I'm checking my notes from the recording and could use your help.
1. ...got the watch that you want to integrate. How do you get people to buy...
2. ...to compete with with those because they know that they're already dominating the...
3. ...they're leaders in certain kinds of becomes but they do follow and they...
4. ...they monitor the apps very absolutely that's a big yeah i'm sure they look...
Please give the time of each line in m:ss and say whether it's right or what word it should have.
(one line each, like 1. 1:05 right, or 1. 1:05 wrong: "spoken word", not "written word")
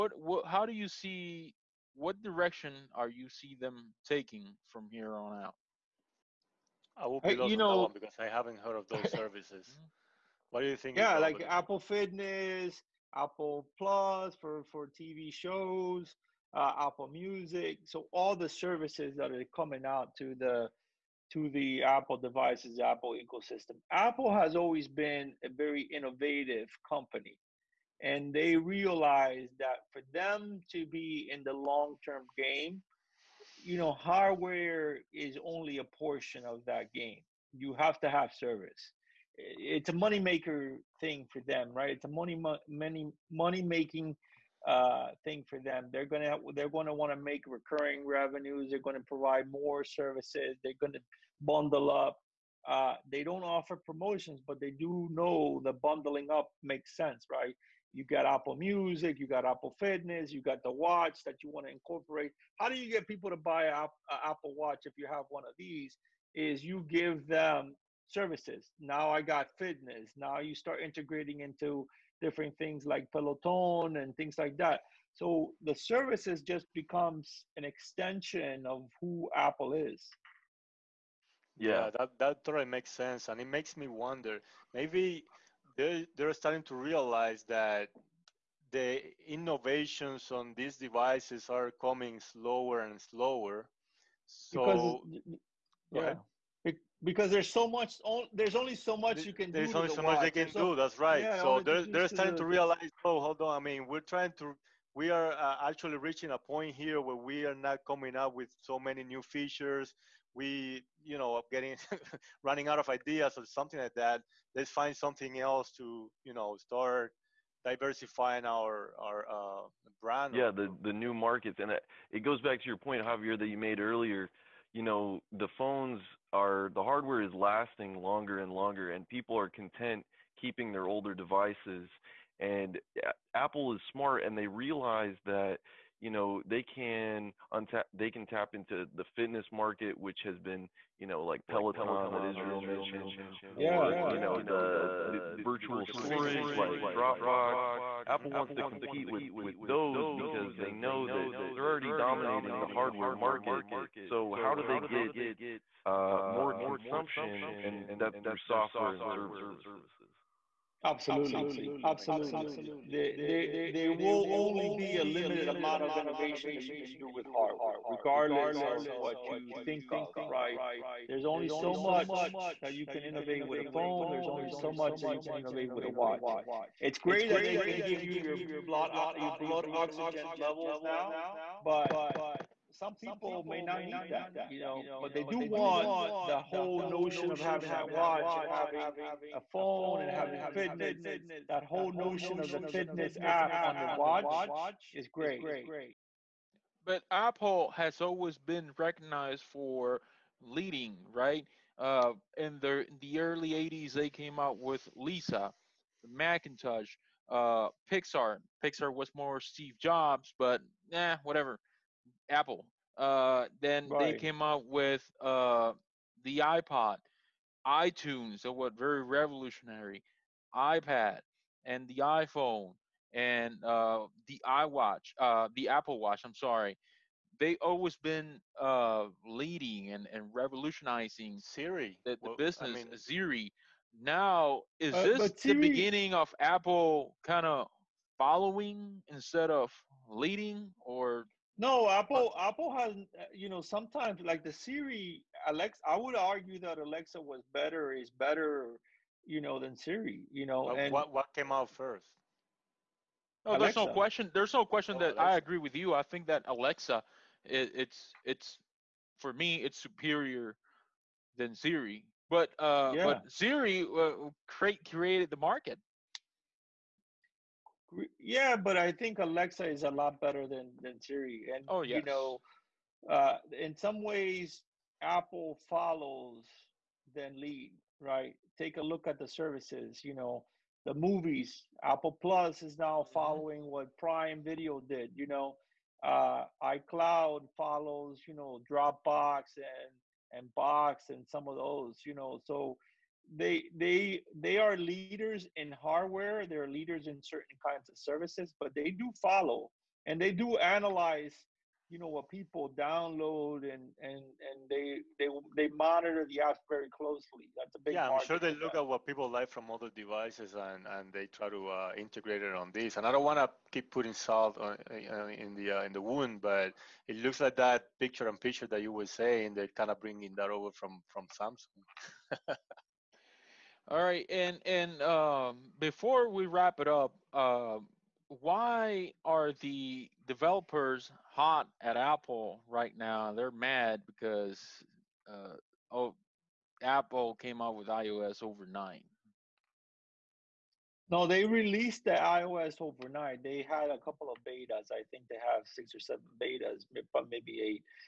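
1. 1:00 wrong: "incorporate", not "integrate"
2. 2:28 right
3. 4:56 wrong: "services", not "becomes"
4. 5:05 wrong: "closely", not "absolutely".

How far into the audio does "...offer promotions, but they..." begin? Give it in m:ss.
0:53.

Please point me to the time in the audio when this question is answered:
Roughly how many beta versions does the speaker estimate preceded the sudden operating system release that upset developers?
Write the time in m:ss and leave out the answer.
5:45.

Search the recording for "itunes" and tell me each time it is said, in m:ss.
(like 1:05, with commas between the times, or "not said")
3:37.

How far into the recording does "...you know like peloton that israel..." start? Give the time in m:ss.
2:20.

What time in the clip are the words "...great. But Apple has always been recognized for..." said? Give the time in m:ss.
3:15.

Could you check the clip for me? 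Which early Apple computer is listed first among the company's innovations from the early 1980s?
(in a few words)
Lisa.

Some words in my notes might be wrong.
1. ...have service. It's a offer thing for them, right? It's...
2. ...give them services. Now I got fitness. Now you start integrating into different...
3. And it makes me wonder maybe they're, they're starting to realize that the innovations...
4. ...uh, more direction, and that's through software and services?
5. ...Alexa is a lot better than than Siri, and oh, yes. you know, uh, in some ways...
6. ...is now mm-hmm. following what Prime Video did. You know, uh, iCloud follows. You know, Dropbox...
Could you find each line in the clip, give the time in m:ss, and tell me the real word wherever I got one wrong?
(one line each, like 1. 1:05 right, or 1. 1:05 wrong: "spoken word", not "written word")
1. 0:38 wrong: "moneymaker", not "offer"
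2. 1:06 right
3. 1:23 right
4. 2:35 wrong: "consumption", not "direction"
5. 4:29 right
6. 4:42 right.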